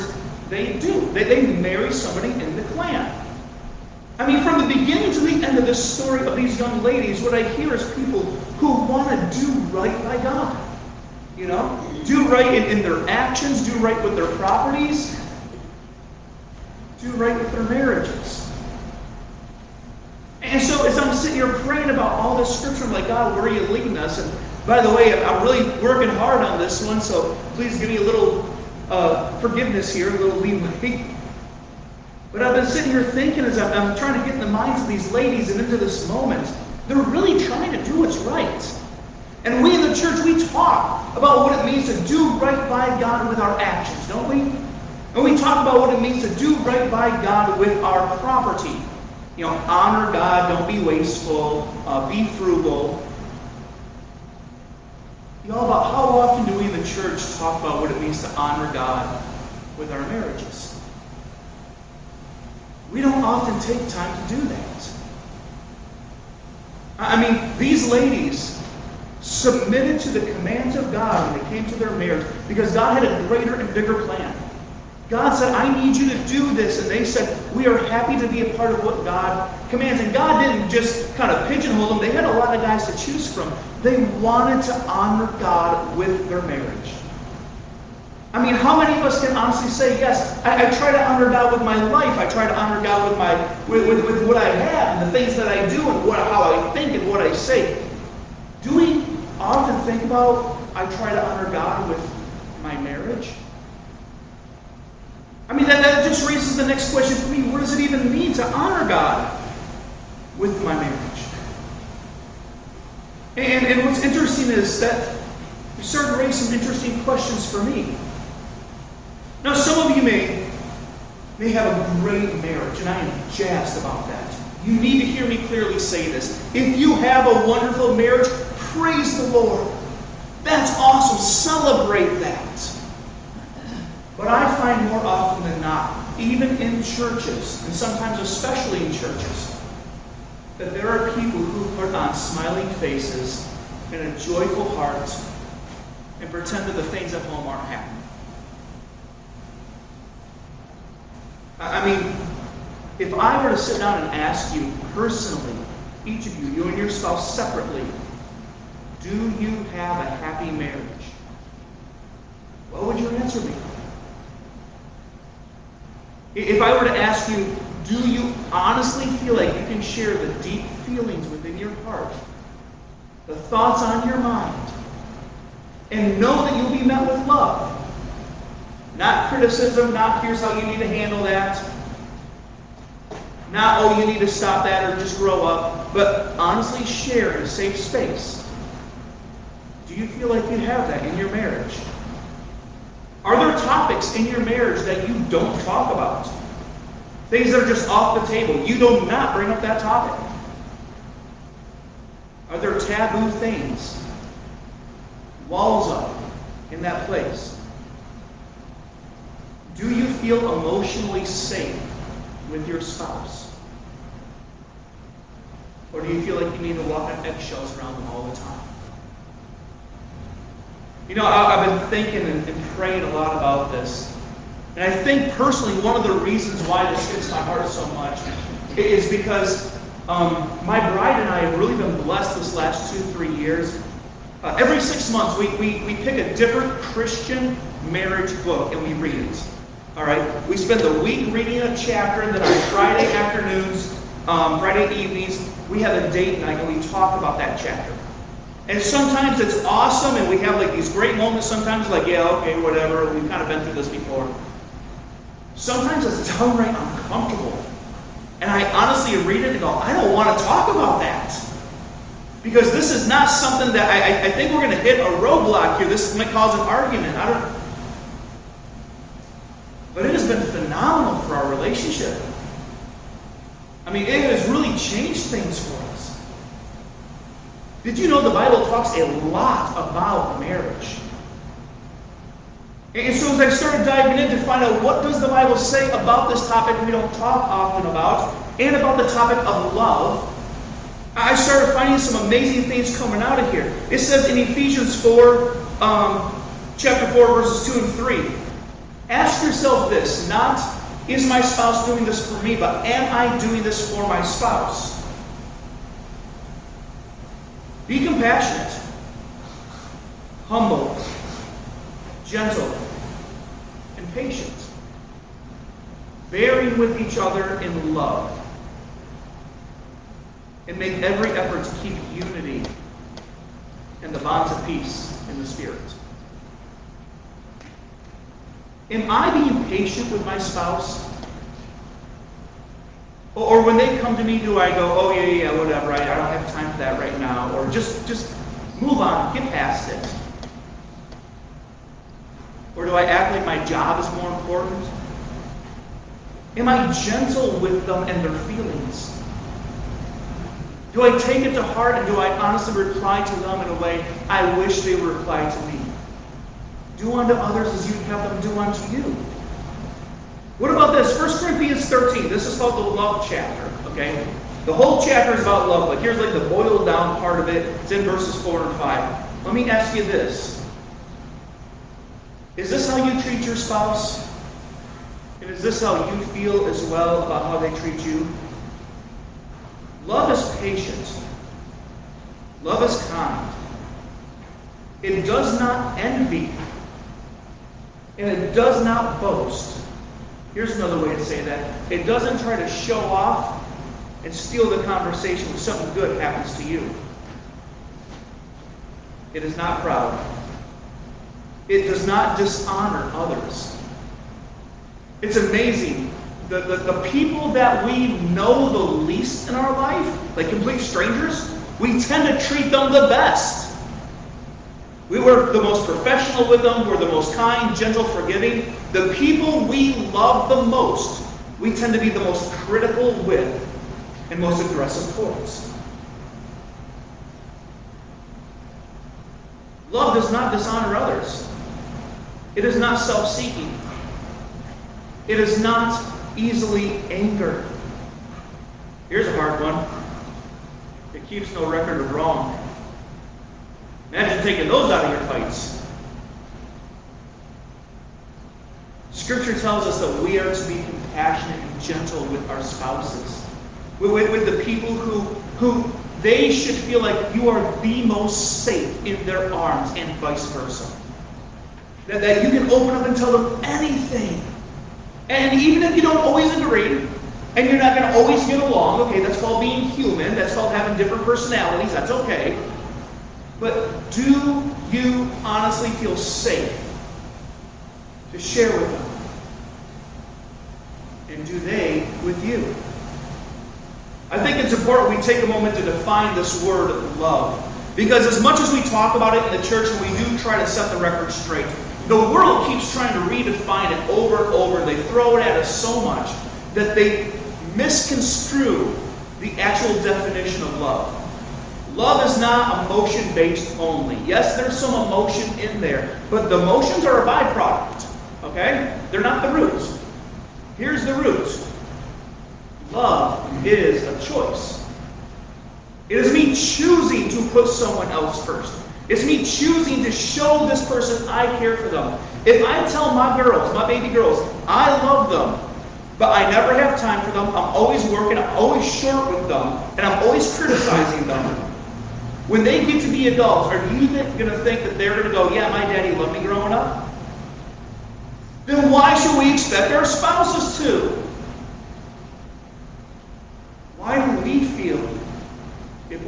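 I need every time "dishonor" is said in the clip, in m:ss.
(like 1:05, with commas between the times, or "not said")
6:42, 7:10.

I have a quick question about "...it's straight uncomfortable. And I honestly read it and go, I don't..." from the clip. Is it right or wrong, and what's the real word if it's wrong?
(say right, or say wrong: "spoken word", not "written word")
wrong: "downright", not "straight".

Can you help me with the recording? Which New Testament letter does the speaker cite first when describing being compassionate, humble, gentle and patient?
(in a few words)
Ephesians.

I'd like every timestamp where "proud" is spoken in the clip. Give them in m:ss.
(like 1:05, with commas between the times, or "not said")
6:39.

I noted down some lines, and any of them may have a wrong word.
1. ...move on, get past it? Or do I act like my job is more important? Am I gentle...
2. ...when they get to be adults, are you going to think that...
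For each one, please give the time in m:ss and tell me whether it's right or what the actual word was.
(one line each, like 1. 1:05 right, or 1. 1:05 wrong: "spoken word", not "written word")
1. 5:38 right
2. 8:52 right.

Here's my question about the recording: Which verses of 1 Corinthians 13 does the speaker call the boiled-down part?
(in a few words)
4 and 5.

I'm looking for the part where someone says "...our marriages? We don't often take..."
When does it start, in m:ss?
0:59.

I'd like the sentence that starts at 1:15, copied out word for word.
God said, I need you to do this.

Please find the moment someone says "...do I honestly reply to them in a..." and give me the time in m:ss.
5:52.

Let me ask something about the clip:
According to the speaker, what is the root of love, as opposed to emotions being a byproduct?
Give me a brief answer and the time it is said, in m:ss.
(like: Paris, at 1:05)
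A choice, at 8:32.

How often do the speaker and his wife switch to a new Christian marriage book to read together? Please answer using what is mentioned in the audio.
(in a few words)
Every 6 months.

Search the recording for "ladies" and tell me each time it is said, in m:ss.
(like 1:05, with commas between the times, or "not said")
0:06, 0:35, 1:07.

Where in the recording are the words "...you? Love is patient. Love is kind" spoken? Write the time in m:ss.
6:18.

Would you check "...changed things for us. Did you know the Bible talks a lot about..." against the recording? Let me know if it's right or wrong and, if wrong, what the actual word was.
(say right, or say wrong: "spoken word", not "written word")
right.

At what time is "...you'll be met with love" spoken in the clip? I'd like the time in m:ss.
2:56.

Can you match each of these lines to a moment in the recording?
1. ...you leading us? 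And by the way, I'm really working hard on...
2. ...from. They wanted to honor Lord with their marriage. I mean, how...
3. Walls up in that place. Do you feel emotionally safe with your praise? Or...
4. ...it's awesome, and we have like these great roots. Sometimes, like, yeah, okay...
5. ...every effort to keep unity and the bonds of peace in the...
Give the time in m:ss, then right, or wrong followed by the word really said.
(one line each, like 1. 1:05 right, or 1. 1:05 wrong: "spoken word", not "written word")
1. 0:23 right
2. 1:23 wrong: "God", not "Lord"
3. 3:25 wrong: "spouse", not "praise"
4. 4:09 wrong: "moments", not "roots"
5. 5:21 right.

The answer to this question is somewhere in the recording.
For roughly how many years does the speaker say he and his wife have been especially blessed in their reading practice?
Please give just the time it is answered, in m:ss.
3:52.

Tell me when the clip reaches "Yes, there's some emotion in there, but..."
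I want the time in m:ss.
8:24.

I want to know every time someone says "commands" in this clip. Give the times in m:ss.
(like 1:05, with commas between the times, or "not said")
1:10, 1:19.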